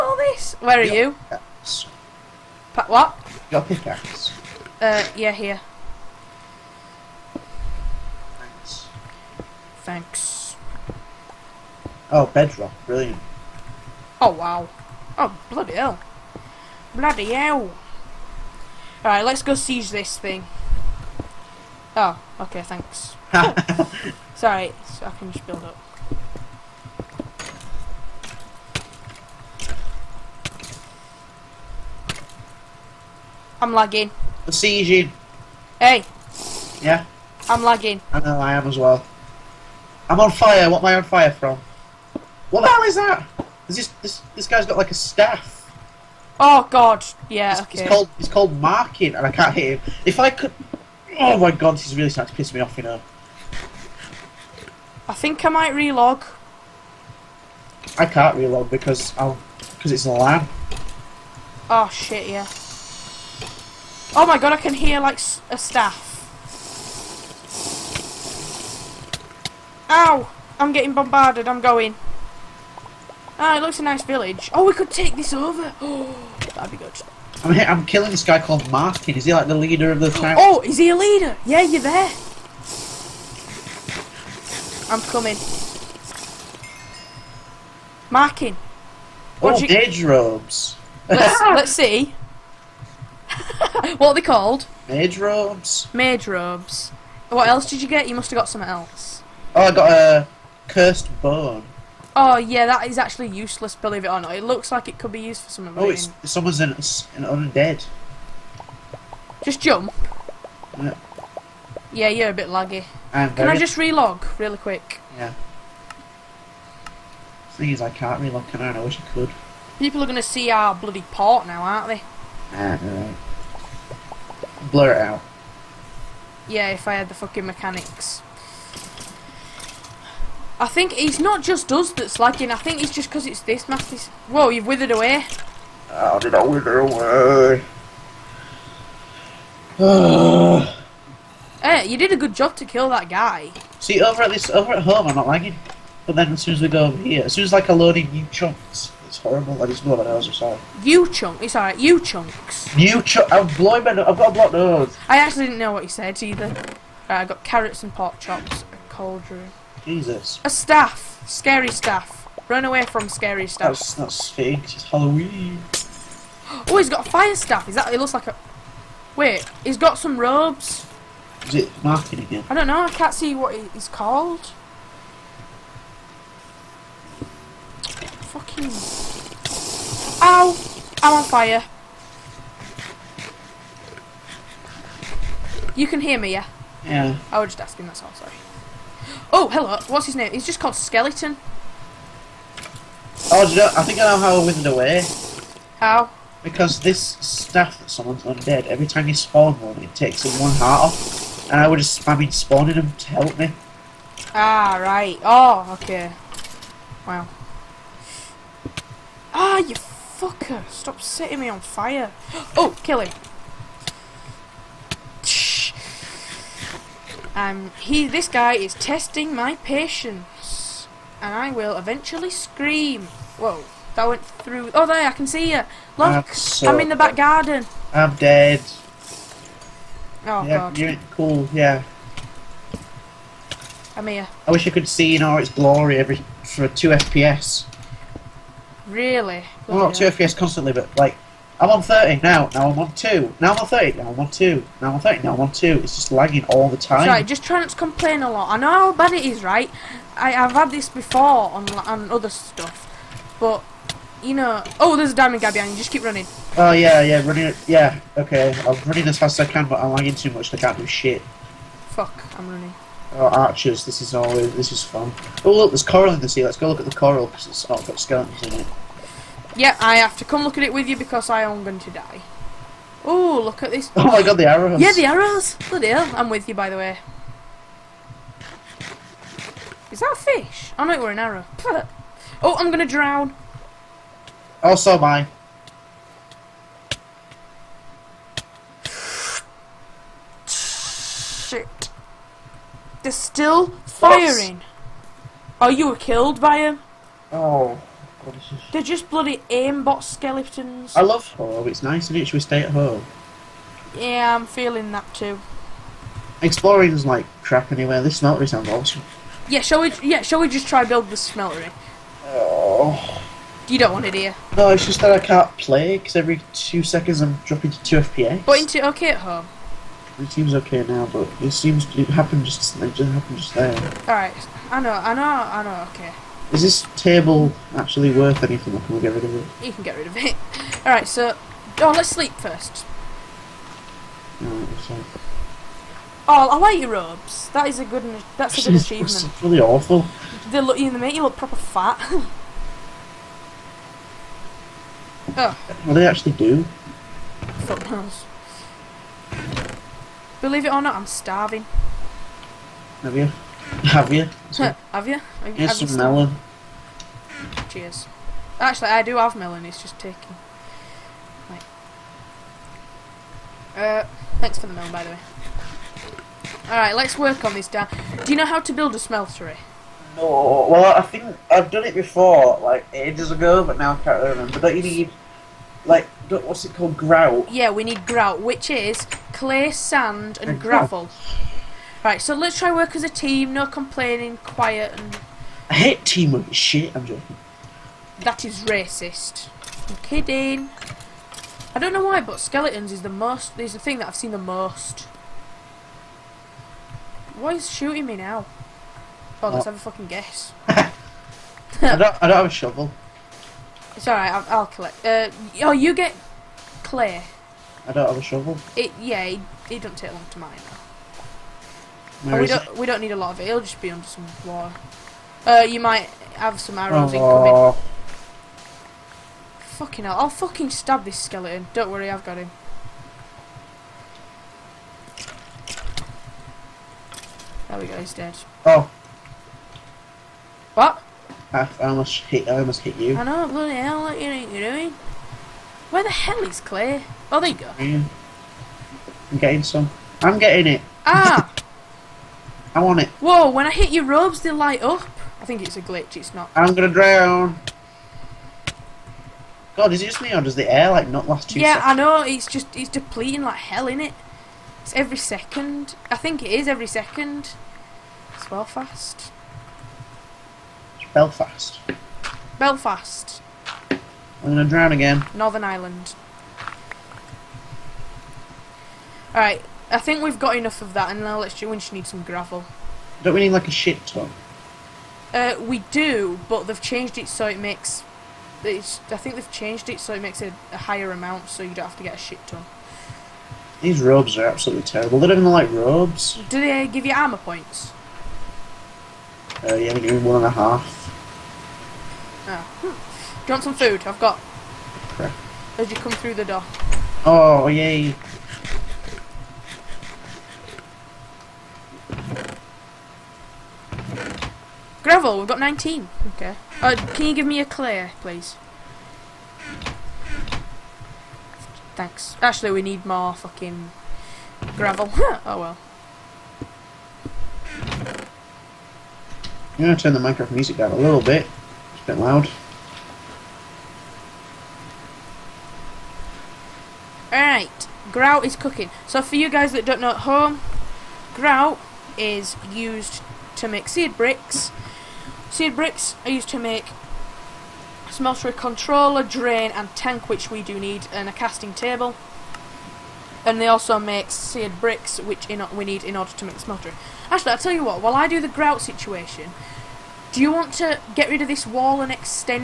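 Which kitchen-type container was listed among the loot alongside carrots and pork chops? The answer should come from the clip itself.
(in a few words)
Cauldron.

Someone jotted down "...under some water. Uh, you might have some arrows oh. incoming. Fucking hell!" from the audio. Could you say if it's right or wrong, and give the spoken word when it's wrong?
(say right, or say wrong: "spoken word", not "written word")
right.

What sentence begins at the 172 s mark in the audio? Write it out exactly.
I can't see what he's called.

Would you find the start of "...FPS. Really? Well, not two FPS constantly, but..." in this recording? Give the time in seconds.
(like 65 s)
236 s.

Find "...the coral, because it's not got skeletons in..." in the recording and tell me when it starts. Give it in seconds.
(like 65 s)
266 s.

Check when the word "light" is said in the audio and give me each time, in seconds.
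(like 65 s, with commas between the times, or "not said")
444 s.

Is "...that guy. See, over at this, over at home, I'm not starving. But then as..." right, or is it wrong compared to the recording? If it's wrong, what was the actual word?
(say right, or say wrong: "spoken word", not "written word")
wrong: "lagging", not "starving".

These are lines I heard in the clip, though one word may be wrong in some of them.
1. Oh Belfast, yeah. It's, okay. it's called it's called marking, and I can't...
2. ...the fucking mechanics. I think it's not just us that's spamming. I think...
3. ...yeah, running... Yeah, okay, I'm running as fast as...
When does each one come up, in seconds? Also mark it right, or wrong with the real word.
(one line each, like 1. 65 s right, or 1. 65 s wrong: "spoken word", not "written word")
1. 46 s wrong: "God", not "Belfast"
2. 127 s wrong: "lagging", not "spamming"
3. 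257 s right.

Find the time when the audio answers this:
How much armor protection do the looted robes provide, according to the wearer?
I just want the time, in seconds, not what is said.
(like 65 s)
490 s.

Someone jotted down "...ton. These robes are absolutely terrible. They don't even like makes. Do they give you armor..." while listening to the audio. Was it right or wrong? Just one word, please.
wrong.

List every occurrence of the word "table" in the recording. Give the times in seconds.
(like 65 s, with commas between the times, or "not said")
326 s, 541 s.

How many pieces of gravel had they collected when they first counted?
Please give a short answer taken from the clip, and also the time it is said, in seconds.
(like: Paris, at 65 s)
19, at 505 s.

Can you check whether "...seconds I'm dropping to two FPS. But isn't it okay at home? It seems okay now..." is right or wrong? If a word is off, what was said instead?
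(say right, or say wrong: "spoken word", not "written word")
right.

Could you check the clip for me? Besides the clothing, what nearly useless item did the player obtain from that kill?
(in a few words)
Cursed bone.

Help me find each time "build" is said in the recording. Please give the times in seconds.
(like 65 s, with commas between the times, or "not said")
25 s, 310 s, 368 s.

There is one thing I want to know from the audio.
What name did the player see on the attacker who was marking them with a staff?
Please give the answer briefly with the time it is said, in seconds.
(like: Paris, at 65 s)
Martin, at 78 s.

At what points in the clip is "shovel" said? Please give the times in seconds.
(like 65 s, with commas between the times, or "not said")
402 s, 408 s.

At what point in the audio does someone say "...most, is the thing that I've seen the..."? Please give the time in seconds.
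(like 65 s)
393 s.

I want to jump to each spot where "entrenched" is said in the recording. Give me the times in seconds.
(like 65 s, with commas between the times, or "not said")
not said.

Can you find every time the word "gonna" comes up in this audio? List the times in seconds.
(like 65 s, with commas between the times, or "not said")
120 s, 446 s, 464 s, 519 s.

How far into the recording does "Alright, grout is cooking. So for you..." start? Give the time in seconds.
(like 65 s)
527 s.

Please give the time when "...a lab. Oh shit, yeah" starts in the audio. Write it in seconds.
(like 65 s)
60 s.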